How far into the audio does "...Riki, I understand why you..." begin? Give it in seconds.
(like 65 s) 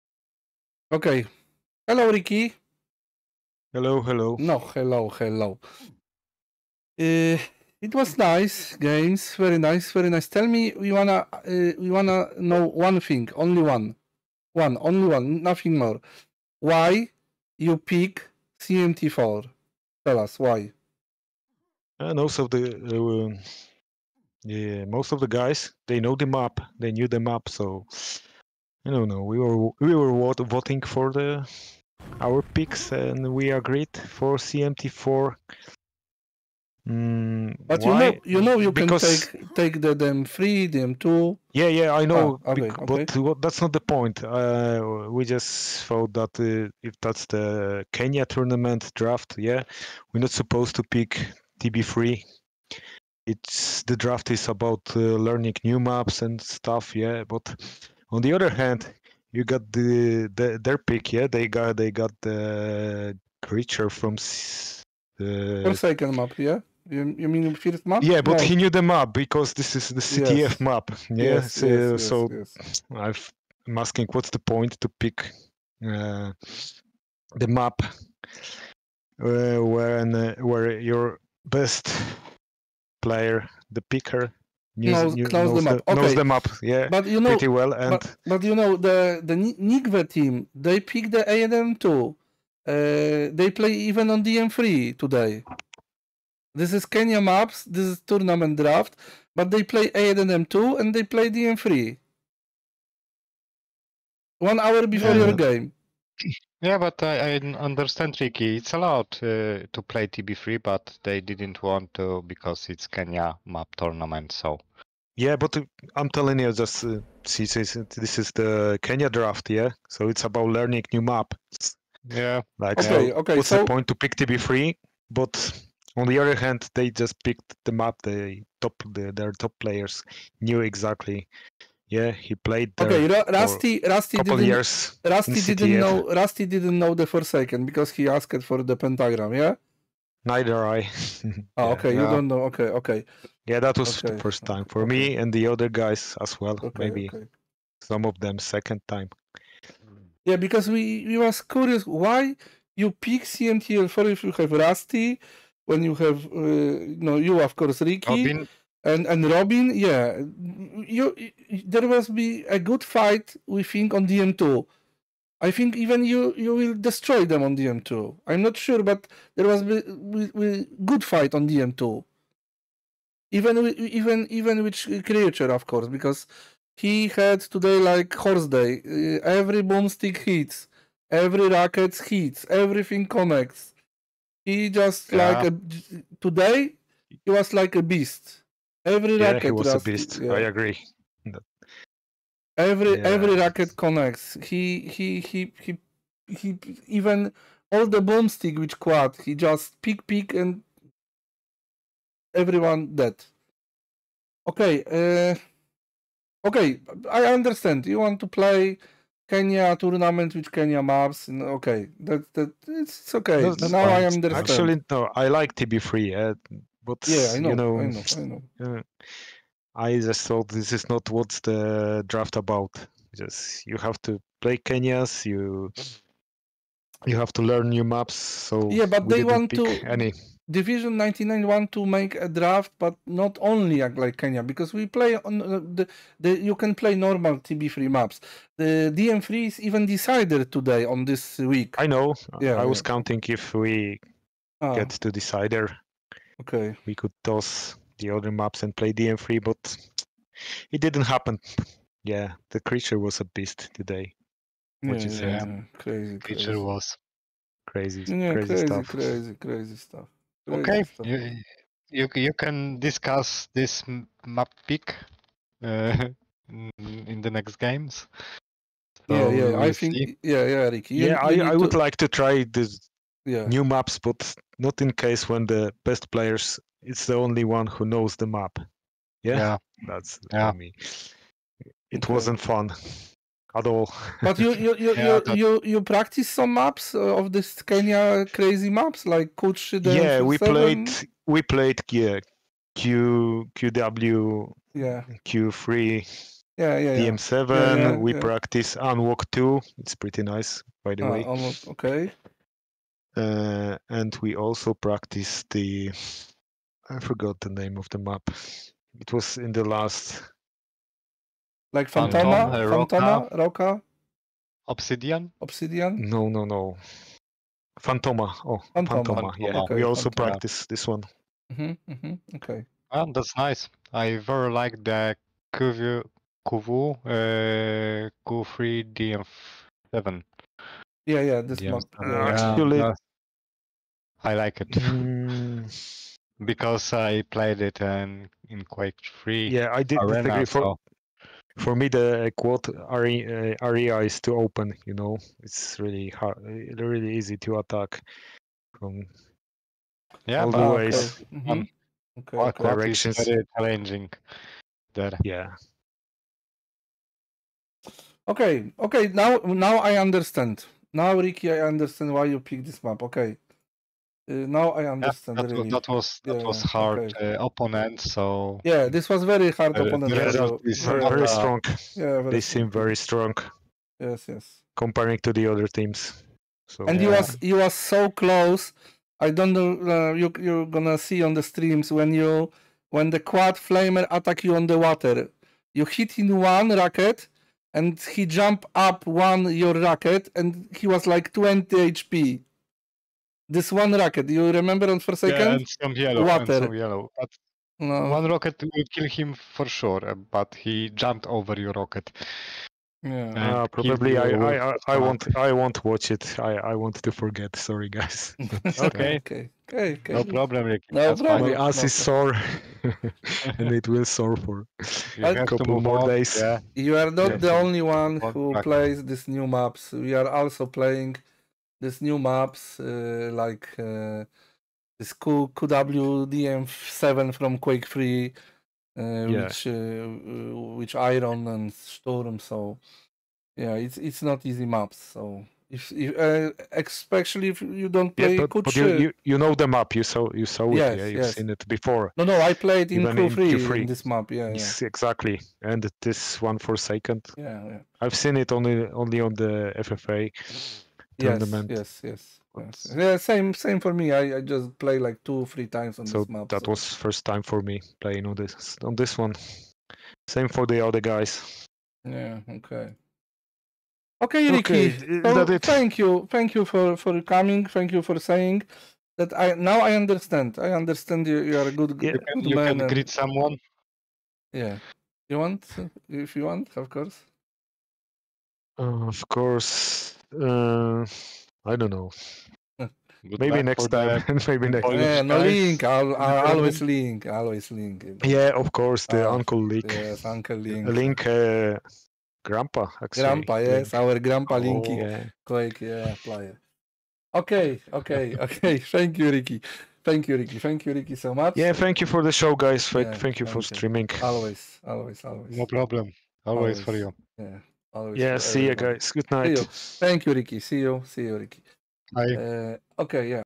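361 s.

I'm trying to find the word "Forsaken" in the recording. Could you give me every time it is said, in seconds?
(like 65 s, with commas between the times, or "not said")
65 s, 394 s.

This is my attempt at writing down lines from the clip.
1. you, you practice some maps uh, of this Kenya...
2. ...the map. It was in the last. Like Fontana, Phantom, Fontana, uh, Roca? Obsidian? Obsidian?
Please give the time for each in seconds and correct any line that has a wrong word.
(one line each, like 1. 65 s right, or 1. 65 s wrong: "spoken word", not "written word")
1. 285 s right
2. 307 s right.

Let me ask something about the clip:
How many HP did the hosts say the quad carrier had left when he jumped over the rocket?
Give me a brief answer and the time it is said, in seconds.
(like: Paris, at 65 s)
20, at 391 s.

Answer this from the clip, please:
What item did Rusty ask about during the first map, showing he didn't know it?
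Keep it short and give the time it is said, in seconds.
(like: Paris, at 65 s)
pentagram, at 138 s.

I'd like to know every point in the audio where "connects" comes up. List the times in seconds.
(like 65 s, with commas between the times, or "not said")
183 s, 193 s.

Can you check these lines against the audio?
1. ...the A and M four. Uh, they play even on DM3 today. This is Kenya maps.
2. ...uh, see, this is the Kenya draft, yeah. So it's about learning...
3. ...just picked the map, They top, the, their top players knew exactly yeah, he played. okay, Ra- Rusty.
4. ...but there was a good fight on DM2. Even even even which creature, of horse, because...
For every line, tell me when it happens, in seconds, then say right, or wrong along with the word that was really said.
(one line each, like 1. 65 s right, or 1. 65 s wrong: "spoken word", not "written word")
1. 91 s wrong: "two", not "four"
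2. 116 s right
3. 126 s right
4. 168 s wrong: "course", not "horse".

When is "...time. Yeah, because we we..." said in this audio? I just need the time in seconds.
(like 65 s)
148 s.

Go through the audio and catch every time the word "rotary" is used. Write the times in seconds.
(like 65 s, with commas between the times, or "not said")
not said.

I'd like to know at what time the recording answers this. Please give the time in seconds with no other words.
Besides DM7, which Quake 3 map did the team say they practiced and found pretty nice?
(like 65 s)
298 s.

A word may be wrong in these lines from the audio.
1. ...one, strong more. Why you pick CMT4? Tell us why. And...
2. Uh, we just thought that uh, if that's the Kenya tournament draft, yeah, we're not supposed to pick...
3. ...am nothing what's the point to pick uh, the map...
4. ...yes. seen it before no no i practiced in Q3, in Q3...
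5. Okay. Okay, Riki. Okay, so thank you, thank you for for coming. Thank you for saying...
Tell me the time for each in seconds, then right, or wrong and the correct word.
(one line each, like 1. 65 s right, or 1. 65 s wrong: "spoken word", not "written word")
1. 15 s wrong: "nothing", not "strong"
2. 44 s right
3. 73 s wrong: "asking", not "nothing"
4. 441 s wrong: "played", not "practiced"
5. 462 s right.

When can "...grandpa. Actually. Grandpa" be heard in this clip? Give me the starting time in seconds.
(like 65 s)
492 s.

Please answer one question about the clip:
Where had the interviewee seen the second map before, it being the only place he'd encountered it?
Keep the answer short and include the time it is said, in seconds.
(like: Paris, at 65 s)
FFA tournament, at 449 s.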